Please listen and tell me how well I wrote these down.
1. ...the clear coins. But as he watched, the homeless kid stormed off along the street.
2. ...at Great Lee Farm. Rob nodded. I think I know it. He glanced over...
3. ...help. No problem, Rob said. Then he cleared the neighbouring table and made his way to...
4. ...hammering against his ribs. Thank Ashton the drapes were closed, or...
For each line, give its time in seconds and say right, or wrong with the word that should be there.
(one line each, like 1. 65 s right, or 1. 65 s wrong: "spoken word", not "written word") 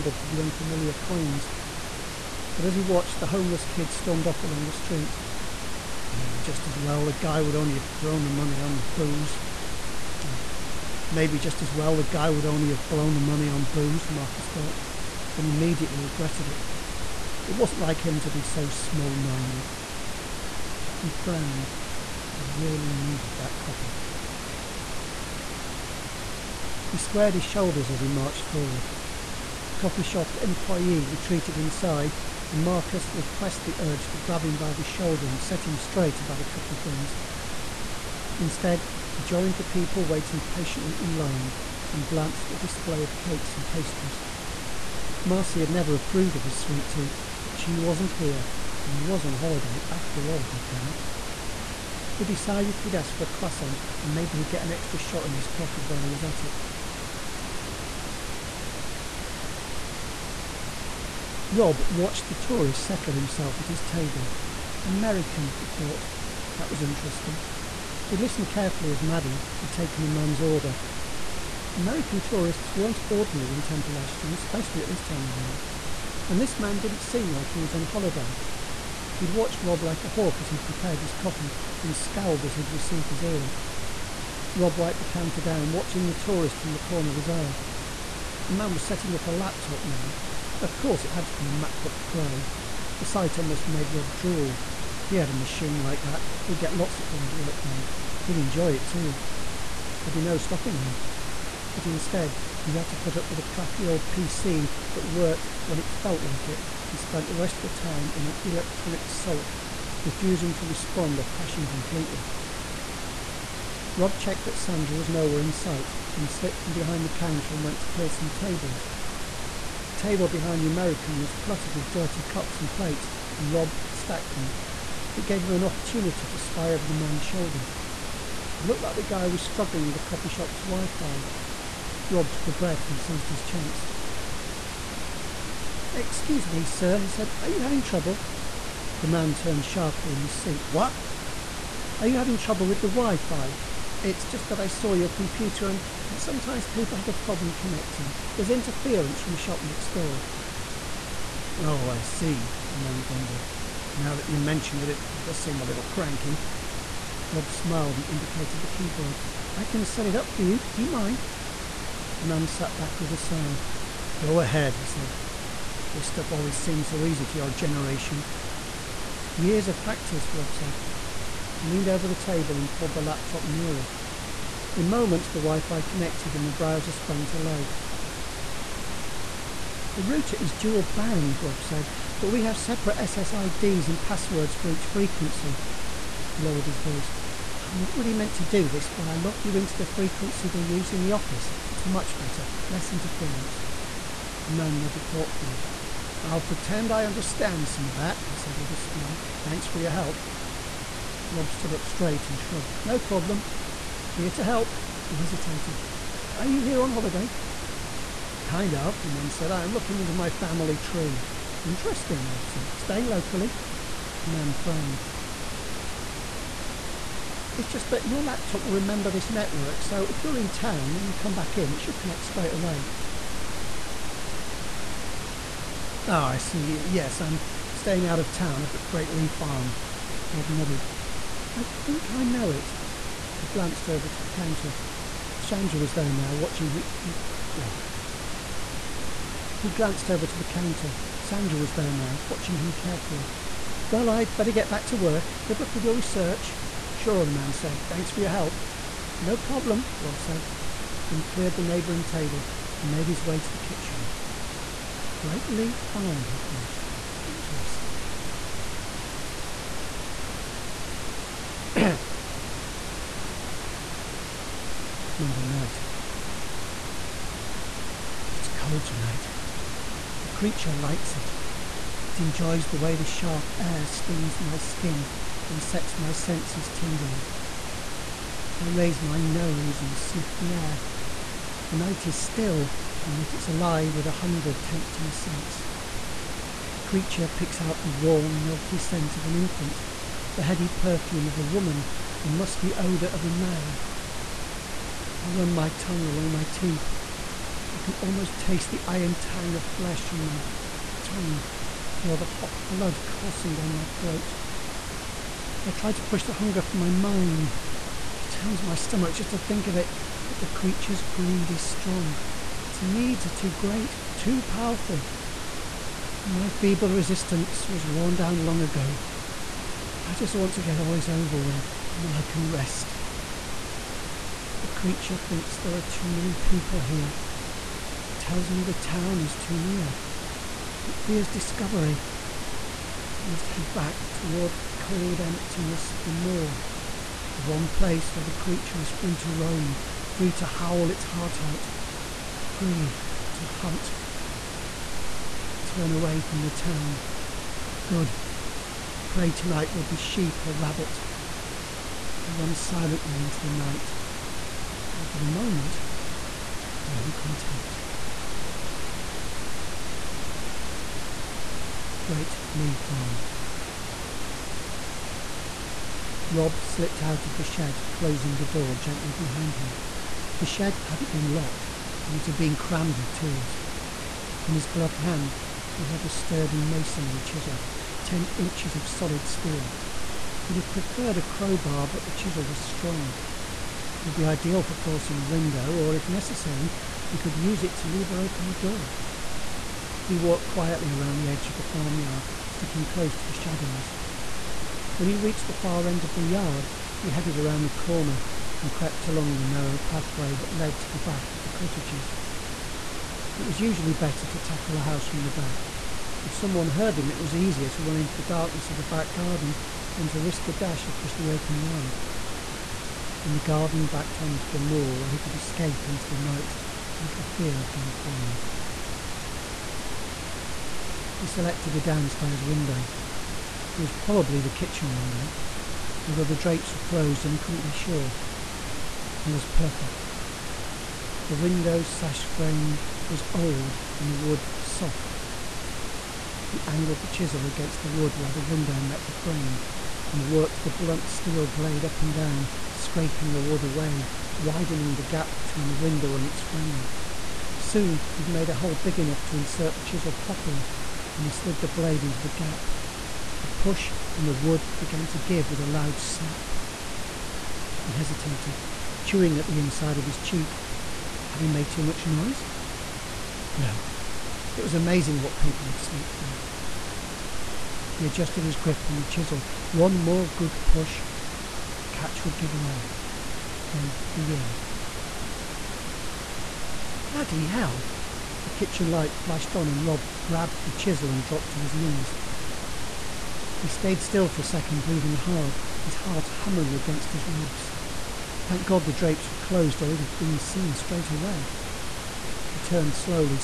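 1. 0 s wrong: "unfamiliar", not "clear"
2. 228 s right
3. 248 s right
4. 486 s wrong: "God", not "Ashton".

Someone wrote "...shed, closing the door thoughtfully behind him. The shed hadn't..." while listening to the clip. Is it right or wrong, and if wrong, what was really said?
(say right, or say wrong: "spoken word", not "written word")
wrong: "gently", not "thoughtfully".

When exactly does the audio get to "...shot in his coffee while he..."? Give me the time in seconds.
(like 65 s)
54 s.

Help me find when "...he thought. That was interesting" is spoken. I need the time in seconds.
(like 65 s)
65 s.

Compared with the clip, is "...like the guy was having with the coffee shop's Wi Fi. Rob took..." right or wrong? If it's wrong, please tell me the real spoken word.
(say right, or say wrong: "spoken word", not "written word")
wrong: "struggling", not "having".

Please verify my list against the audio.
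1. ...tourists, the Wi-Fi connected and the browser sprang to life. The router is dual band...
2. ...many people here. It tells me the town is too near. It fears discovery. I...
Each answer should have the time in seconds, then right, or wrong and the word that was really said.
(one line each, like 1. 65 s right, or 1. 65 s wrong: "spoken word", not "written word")
1. 174 s wrong: "moments", not "tourists"
2. 326 s right.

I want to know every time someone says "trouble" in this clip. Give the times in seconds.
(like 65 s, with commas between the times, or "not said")
137 s, 142 s.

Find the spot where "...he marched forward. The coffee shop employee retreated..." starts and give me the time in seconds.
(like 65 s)
28 s.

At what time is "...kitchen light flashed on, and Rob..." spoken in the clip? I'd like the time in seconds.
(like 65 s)
478 s.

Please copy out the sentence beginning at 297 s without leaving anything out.
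I can almost taste the iron tang of flesh on my tongue, feel the hot blood coursing down my throat.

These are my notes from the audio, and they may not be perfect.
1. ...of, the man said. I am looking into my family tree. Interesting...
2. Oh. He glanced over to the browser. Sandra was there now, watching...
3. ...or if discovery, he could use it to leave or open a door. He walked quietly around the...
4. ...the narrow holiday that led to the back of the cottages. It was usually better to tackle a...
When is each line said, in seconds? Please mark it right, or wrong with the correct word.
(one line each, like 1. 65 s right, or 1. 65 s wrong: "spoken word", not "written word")
1. 208 s right
2. 237 s wrong: "counter", not "browser"
3. 385 s wrong: "necessary", not "discovery"
4. 399 s wrong: "pathway", not "holiday".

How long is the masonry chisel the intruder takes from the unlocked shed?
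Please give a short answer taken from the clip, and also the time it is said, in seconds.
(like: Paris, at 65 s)
10 inches, at 378 s.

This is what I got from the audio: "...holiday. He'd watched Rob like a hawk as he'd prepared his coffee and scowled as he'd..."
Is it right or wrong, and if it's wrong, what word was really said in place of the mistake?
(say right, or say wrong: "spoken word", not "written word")
right.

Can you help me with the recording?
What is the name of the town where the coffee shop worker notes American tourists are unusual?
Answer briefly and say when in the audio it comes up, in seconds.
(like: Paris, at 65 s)
Temple Ashton, at 73 s.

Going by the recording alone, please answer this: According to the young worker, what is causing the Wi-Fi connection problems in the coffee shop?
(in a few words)
the shop next door.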